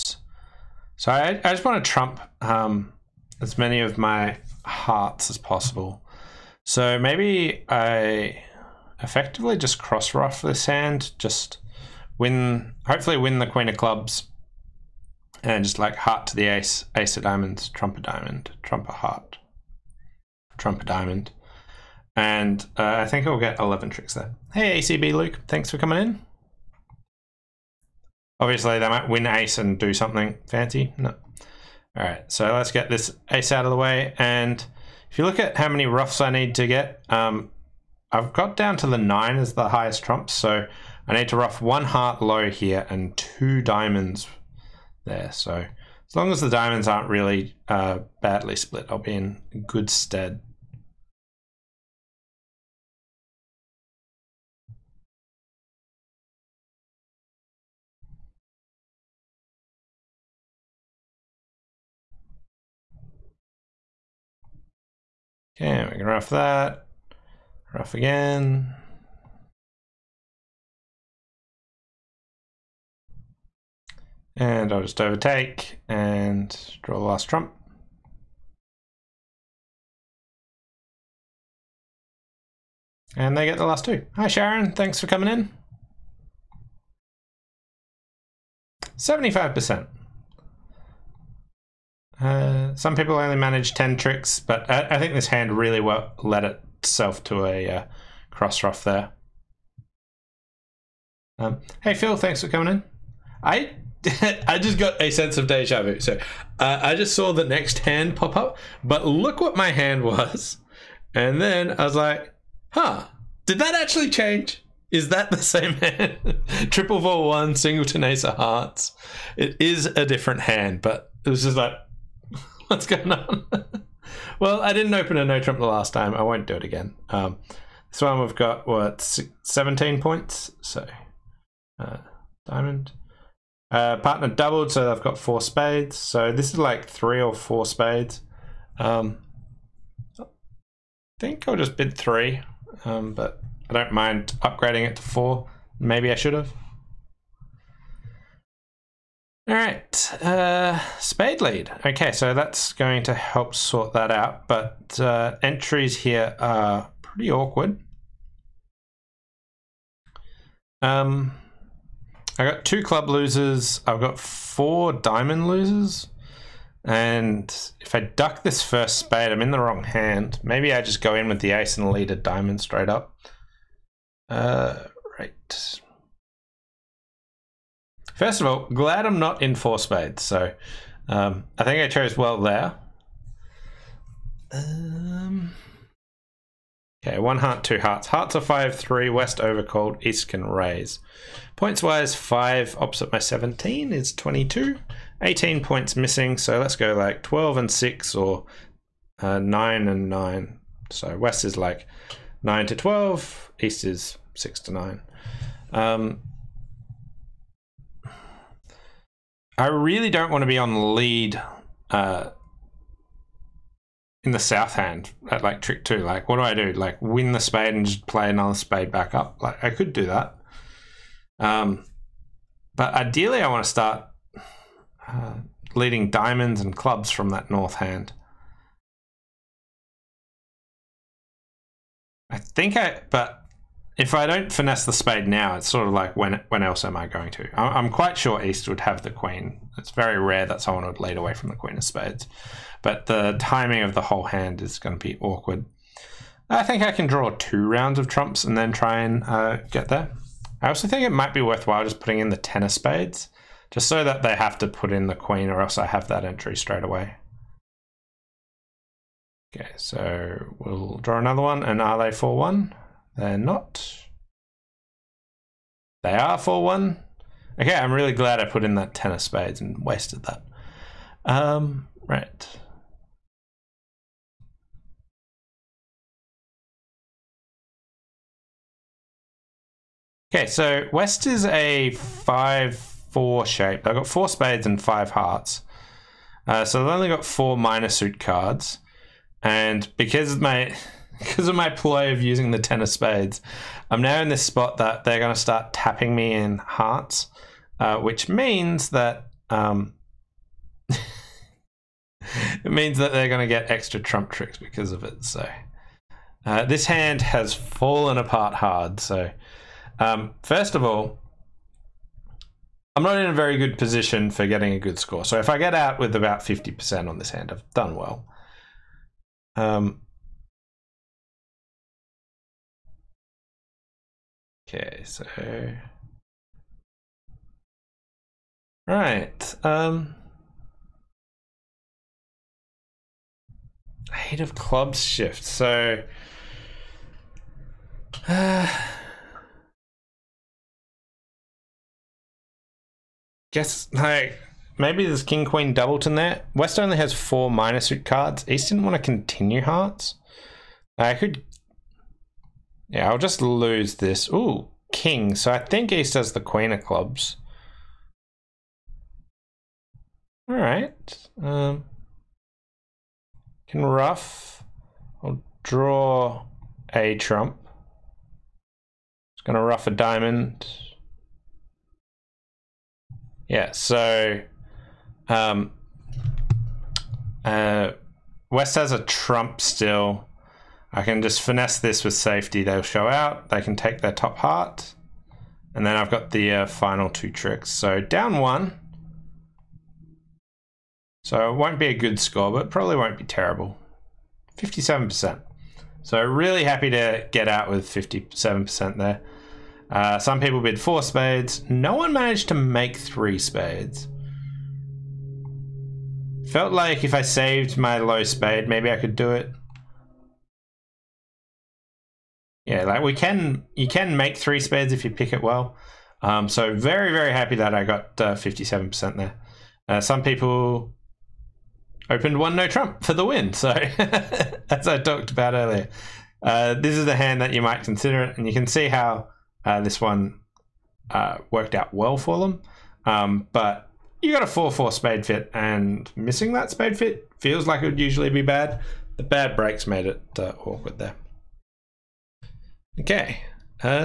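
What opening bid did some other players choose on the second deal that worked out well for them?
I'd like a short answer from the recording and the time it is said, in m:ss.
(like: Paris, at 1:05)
one no trump, at 7:02.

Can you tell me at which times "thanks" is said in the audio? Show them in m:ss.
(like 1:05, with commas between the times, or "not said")
0:25, 1:24, 1:42.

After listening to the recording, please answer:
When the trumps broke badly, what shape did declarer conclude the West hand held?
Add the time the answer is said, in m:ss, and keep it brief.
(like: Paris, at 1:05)
5-4, at 4:41.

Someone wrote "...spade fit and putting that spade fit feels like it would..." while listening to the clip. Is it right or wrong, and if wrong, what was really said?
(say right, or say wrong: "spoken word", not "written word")
wrong: "missing", not "putting".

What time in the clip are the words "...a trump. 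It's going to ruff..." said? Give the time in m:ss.
6:06.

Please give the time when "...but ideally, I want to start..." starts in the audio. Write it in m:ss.
3:42.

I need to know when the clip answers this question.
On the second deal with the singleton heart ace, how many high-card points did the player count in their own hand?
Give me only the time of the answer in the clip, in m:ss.
2:09.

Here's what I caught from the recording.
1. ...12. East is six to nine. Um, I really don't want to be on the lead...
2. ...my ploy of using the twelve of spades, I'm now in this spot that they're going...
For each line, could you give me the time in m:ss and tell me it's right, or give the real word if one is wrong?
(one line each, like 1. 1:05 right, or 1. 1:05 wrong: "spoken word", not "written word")
1. 3:22 right
2. 4:51 wrong: "ten", not "twelve".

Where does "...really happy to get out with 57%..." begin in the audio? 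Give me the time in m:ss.
6:36.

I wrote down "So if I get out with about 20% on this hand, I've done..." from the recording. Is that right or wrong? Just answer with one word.
wrong.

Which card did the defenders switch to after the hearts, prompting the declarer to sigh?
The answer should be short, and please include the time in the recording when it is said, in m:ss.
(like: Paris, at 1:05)
eight of clubs, at 5:34.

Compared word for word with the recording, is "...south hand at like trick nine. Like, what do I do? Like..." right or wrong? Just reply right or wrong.
wrong.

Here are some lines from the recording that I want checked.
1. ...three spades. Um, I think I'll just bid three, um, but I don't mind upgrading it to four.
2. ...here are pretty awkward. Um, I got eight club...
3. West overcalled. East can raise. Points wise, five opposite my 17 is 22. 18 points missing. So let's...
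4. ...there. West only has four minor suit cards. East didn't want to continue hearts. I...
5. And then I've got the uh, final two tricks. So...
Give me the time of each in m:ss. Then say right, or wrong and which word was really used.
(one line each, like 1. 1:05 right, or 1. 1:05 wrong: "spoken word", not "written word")
1. 2:17 wrong: "four", not "three"
2. 2:35 wrong: "two", not "eight"
3. 3:09 right
4. 5:46 right
5. 6:25 right.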